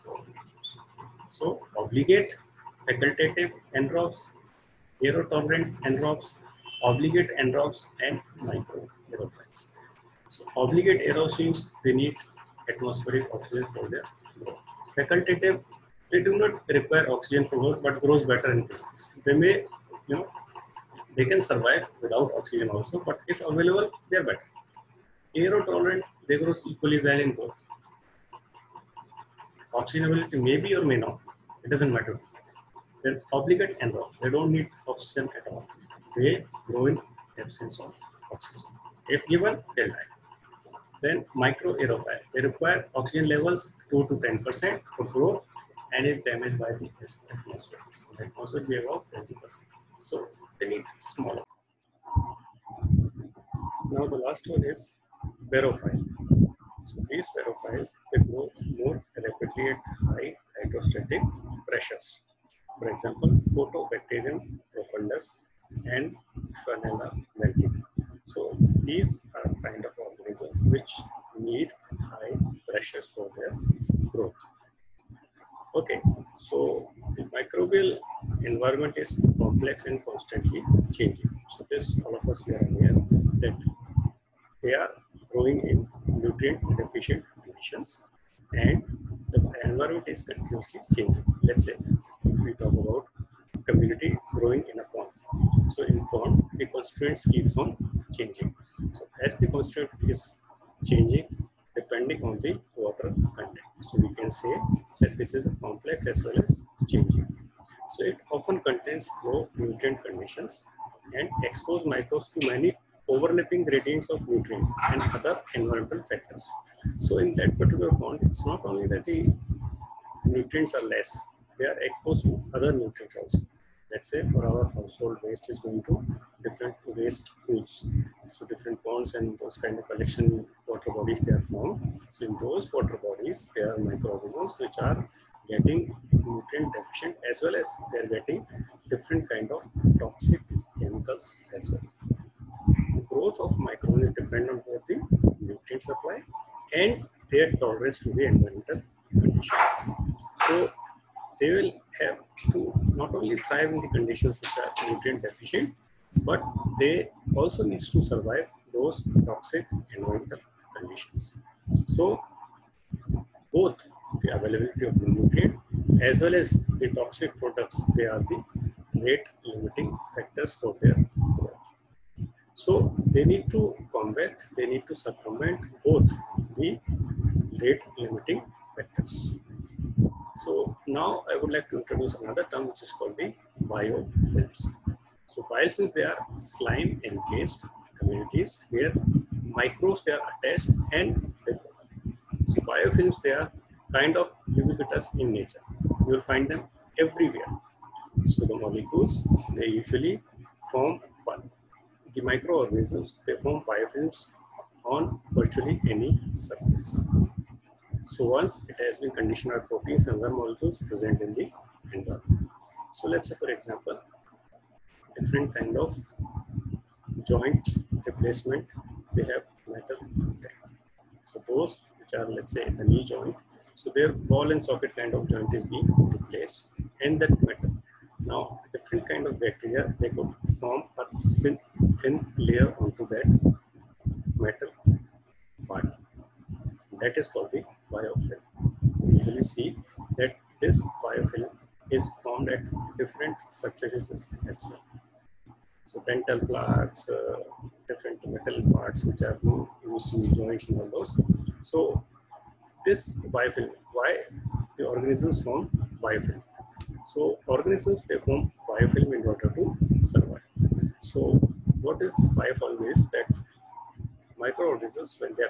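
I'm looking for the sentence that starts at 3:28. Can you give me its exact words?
So once it has been conditioned by proteins and other molecules present in the environment.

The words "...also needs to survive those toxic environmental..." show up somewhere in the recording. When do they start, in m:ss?
2:37.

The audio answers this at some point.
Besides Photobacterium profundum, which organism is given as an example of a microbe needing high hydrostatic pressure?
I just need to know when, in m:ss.
1:06.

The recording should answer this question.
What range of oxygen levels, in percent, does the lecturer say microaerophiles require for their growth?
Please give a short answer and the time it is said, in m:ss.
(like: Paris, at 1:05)
2 to 10%, at 0:43.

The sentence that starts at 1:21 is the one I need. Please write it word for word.
So this, all of us, we are aware that they are growing in nutrient deficient conditions and the environment is continuously changing.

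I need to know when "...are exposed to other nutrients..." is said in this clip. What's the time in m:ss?
2:01.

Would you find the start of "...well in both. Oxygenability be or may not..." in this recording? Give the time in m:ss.
0:27.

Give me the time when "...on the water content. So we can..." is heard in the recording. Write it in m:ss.
1:42.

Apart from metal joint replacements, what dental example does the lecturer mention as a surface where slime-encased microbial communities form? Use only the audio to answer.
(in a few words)
Dental plaques.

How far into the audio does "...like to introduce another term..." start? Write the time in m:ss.
3:01.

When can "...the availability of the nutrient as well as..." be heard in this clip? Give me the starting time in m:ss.
2:44.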